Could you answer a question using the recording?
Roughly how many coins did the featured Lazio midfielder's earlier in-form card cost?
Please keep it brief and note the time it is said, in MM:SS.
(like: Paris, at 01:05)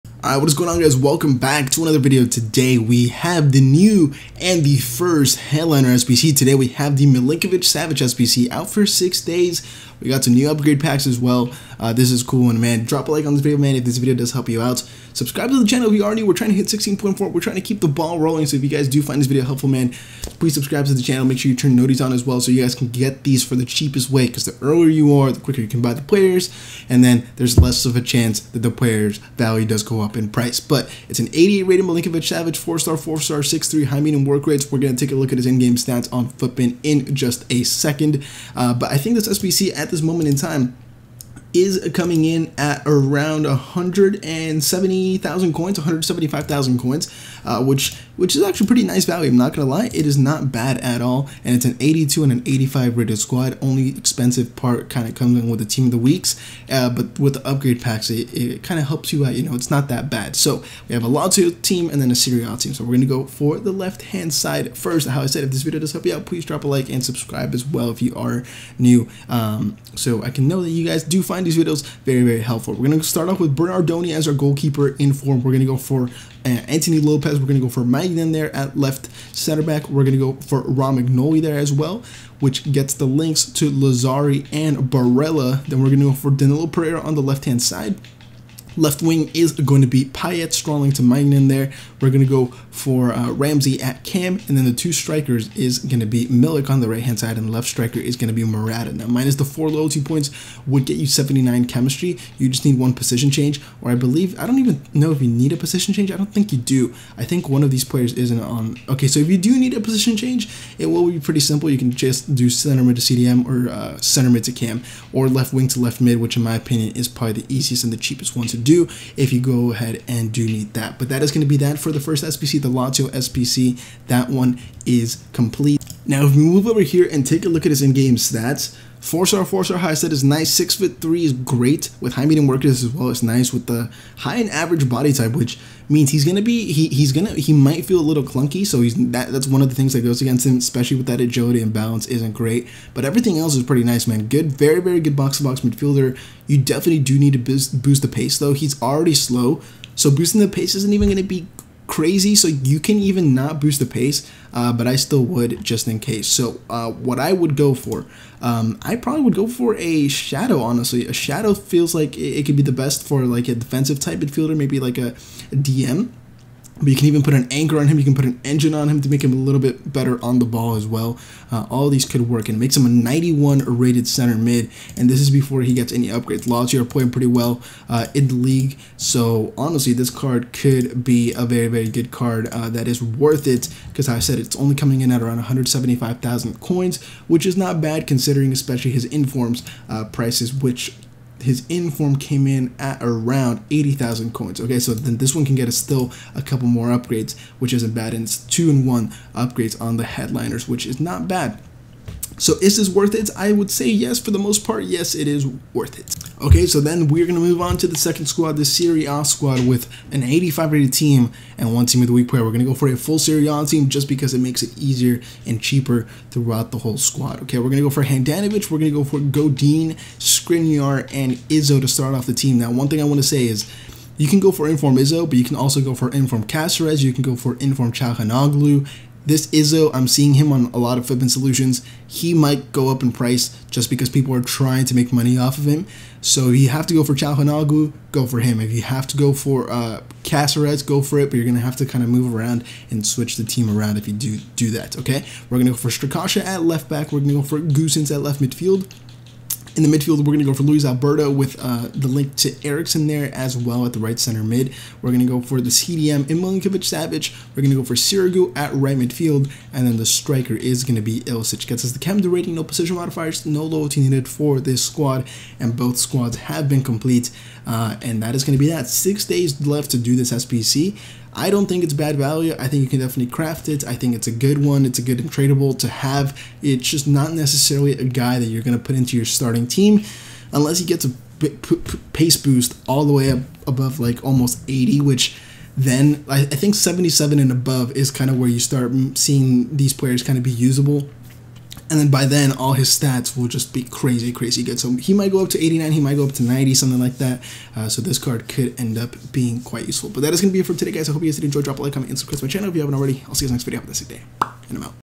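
80,000 coins, at 03:13.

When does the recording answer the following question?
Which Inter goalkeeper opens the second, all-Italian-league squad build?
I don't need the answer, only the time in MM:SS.
03:38.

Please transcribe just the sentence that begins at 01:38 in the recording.
Now, minus the four loyalty points would get you 79 chemistry.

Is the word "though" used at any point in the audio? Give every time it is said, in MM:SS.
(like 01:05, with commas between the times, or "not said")
02:28.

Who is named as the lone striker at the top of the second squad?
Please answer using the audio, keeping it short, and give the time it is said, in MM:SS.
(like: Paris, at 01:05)
Ilicic, at 04:21.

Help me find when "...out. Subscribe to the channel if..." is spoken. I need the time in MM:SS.
00:14.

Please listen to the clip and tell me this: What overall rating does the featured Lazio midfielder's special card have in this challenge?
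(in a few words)
88.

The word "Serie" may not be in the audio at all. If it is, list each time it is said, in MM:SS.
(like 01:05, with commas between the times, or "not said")
01:02, 03:28, 03:33.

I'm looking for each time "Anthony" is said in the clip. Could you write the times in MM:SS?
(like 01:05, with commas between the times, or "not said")
01:16.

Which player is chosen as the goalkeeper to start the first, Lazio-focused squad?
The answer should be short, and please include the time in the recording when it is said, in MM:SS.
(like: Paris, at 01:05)
Bernardoni, at 01:13.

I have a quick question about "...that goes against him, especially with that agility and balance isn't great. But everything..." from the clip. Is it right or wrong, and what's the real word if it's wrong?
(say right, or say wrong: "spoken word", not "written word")
right.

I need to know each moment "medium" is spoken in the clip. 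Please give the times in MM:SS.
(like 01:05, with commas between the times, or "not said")
00:34, 02:12.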